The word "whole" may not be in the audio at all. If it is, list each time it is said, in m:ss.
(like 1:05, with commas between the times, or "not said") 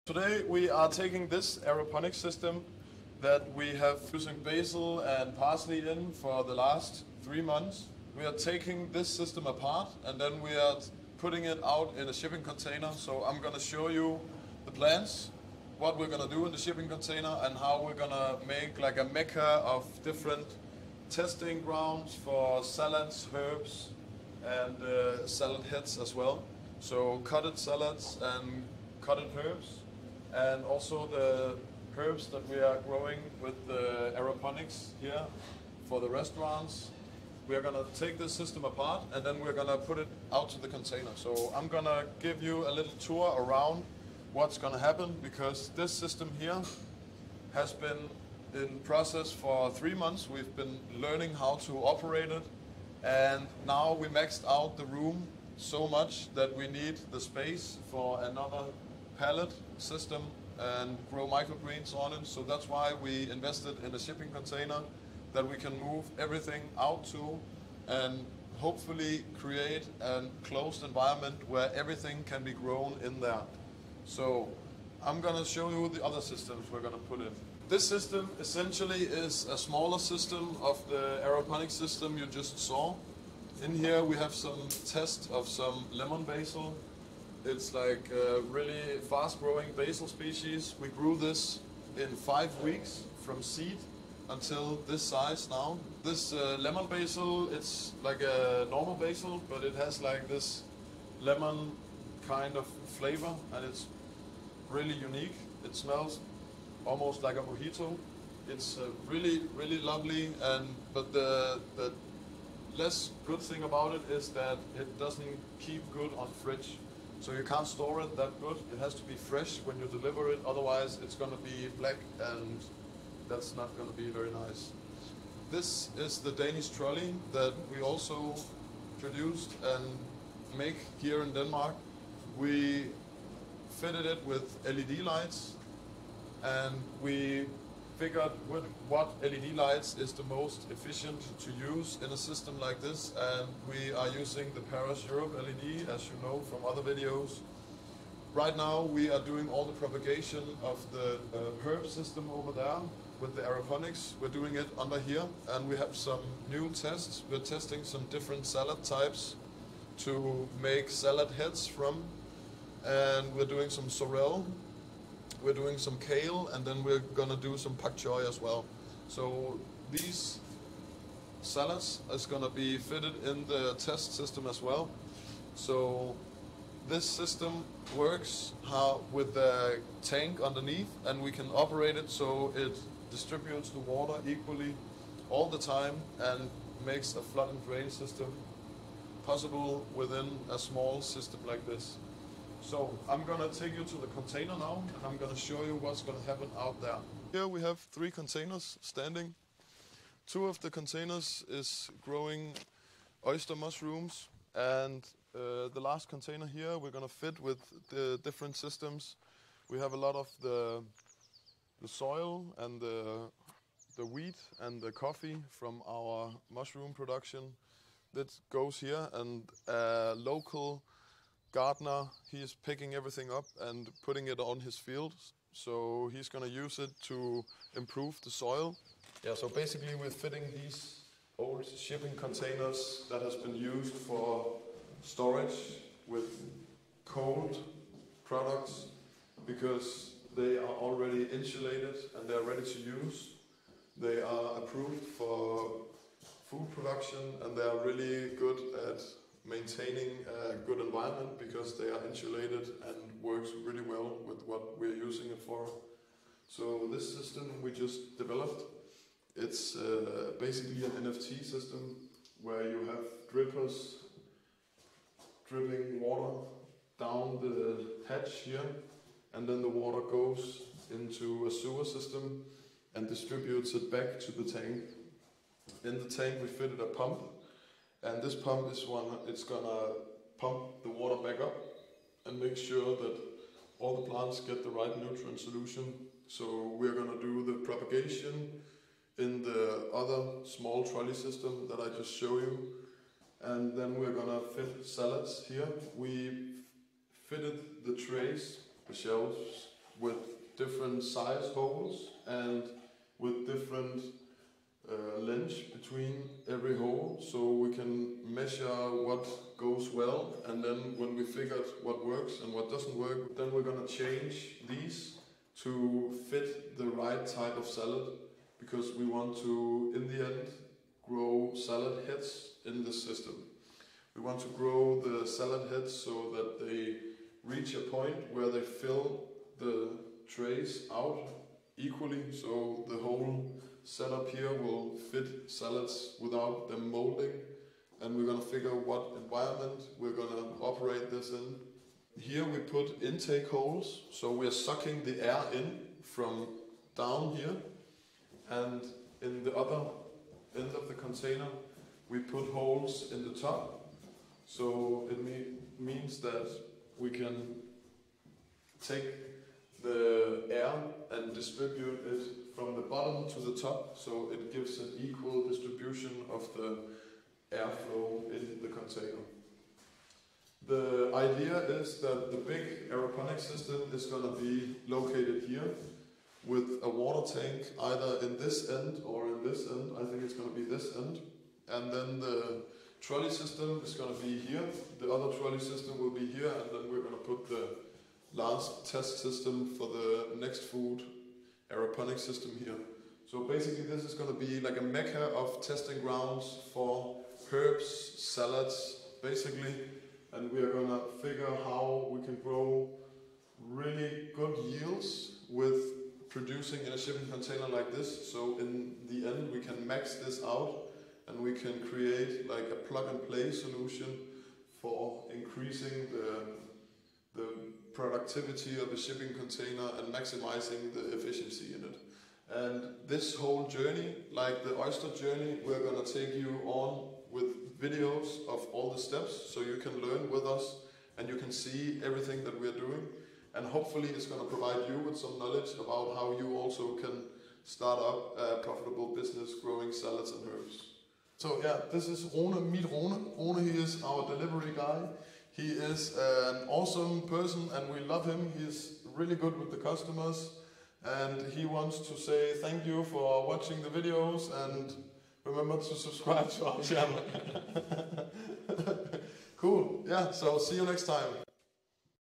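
5:32, 7:03.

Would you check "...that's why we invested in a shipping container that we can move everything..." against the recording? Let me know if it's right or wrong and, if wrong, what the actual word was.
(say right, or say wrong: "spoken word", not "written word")
right.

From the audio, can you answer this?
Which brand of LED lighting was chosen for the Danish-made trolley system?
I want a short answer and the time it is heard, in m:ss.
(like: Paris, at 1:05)
Parus Europe, at 2:24.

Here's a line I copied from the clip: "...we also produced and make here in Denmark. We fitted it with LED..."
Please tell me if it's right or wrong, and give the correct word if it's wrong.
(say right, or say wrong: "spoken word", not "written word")
right.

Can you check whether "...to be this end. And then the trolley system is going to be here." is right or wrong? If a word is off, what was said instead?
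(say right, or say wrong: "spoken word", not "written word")
right.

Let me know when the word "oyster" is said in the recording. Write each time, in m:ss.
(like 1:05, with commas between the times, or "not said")
3:23, 7:04.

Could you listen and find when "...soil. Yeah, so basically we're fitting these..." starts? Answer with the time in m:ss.
3:48.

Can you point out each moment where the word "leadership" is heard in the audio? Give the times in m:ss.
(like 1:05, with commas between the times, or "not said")
not said.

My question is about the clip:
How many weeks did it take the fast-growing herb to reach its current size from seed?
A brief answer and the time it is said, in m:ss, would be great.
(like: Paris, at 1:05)
5 weeks, at 1:32.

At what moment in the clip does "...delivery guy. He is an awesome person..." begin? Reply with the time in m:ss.
7:24.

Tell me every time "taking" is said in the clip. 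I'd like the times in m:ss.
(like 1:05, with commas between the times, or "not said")
0:00, 0:08.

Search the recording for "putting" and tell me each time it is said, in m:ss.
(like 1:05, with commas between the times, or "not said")
0:11, 3:44.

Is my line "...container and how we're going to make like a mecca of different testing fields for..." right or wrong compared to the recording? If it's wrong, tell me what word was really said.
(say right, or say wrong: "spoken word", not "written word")
wrong: "grounds", not "fields".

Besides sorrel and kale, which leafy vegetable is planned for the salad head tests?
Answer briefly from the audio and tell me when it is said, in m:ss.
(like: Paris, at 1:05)
Pak choy, at 2:47.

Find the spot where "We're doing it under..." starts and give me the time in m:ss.
2:34.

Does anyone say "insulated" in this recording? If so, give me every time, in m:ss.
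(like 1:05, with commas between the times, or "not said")
4:01, 4:12.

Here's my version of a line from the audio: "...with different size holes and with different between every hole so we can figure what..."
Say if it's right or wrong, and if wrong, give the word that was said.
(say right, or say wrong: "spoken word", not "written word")
wrong: "measure", not "figure".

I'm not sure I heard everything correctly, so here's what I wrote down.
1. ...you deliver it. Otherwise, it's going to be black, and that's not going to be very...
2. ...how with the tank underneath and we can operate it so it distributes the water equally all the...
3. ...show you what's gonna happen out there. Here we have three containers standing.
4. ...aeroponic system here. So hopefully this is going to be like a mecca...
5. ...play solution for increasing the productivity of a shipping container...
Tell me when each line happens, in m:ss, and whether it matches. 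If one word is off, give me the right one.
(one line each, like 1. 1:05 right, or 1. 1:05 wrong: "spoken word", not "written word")
1. 1:59 right
2. 2:58 right
3. 3:15 right
4. 6:31 wrong: "basically", not "hopefully"
5. 6:53 right.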